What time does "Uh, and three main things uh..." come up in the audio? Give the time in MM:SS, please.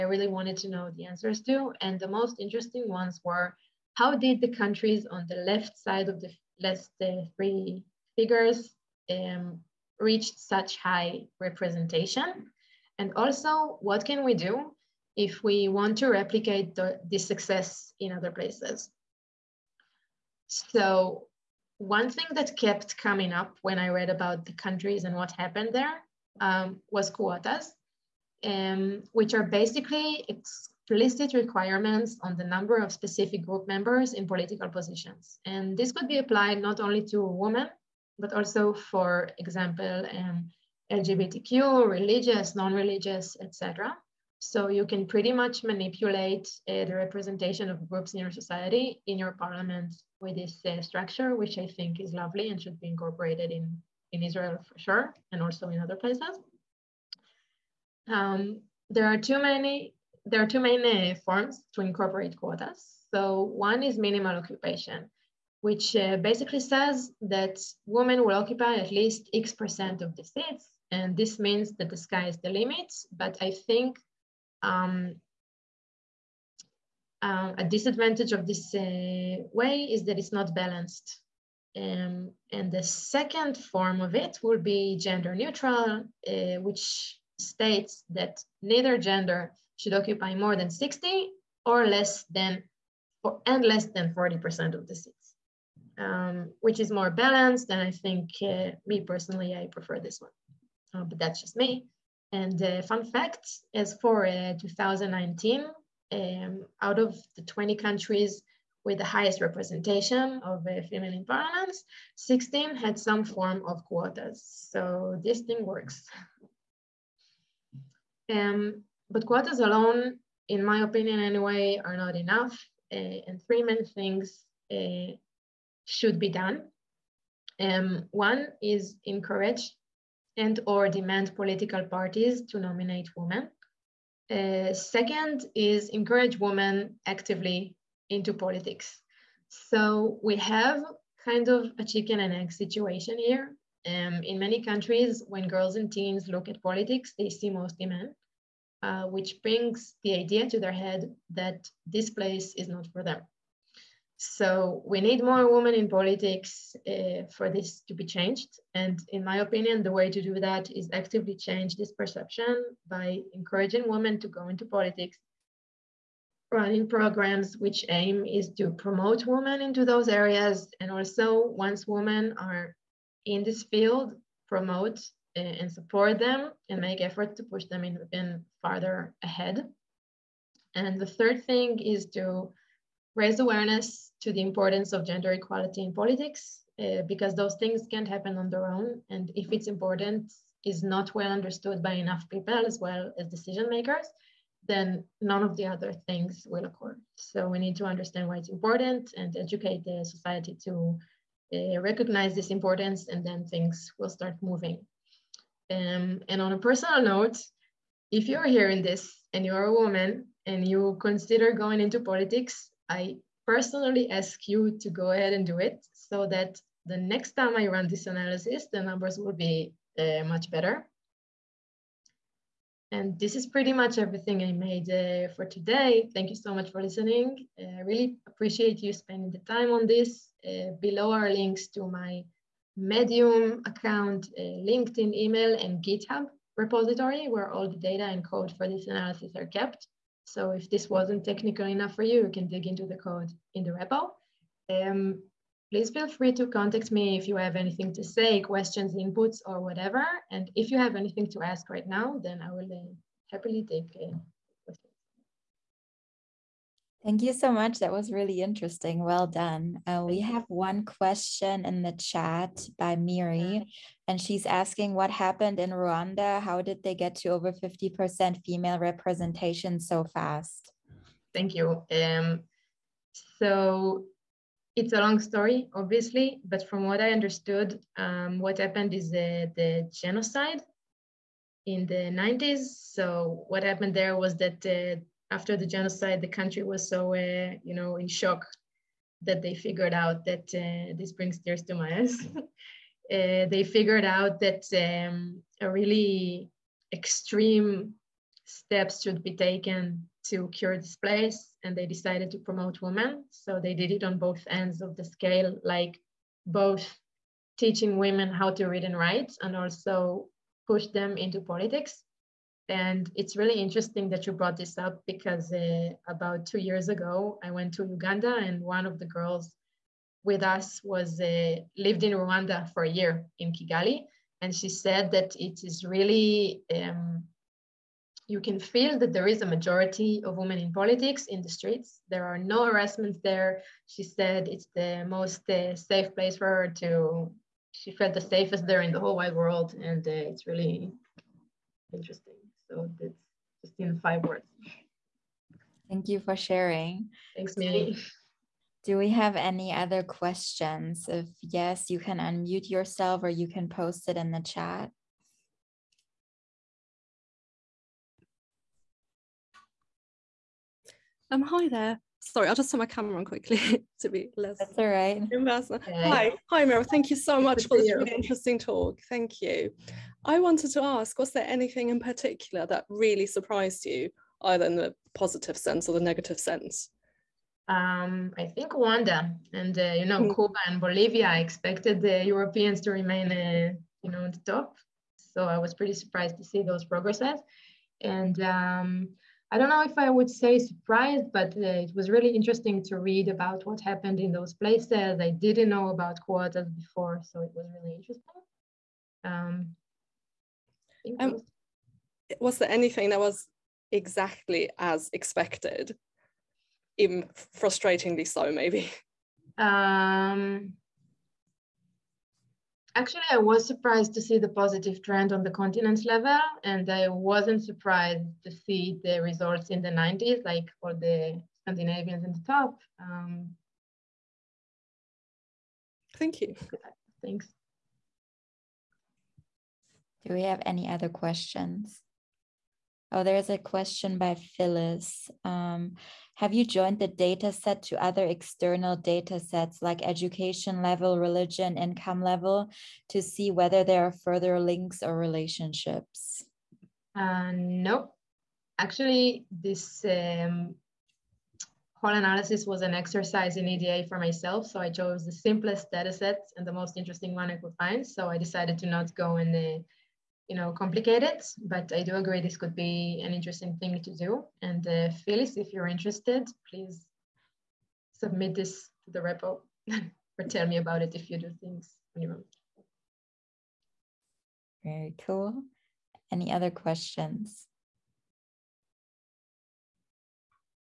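02:02.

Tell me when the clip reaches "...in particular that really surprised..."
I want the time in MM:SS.
06:11.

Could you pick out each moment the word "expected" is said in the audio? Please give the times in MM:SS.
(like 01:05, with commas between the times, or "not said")
06:21, 06:45.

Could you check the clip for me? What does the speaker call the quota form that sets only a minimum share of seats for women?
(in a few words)
Minimal occupation.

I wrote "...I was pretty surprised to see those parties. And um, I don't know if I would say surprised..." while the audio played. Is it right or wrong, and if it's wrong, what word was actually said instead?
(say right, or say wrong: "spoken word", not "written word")
wrong: "progresses", not "parties".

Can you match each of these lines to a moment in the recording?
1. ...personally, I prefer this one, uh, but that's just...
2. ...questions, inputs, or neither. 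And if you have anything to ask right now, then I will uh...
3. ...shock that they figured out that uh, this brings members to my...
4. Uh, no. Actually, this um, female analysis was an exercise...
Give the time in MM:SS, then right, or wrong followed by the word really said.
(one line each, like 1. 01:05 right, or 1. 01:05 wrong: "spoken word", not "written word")
1. 01:39 right
2. 04:08 wrong: "whatever", not "neither"
3. 04:48 wrong: "tears", not "members"
4. 07:27 wrong: "whole", not "female".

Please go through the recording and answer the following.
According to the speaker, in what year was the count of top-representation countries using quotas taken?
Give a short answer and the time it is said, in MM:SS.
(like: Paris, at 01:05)
2019, at 01:44.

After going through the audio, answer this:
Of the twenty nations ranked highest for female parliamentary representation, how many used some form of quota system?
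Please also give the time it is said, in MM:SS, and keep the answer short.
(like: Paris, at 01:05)
16, at 01:52.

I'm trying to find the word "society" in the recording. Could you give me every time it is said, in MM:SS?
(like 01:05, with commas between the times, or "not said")
00:48, 03:20.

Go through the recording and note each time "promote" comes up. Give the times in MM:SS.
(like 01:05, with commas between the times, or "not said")
02:48, 02:54, 05:02.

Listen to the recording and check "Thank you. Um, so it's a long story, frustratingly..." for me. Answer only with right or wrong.
wrong.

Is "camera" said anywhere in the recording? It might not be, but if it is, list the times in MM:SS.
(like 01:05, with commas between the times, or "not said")
06:02.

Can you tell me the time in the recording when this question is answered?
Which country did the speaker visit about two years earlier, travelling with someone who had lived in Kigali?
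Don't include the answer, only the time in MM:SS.
05:17.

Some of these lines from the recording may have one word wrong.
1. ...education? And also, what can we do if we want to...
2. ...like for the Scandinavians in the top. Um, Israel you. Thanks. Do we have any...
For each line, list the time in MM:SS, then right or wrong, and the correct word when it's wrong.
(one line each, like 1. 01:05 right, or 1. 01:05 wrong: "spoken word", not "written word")
1. 00:11 wrong: "representation", not "education"
2. 07:00 wrong: "Thank", not "Israel".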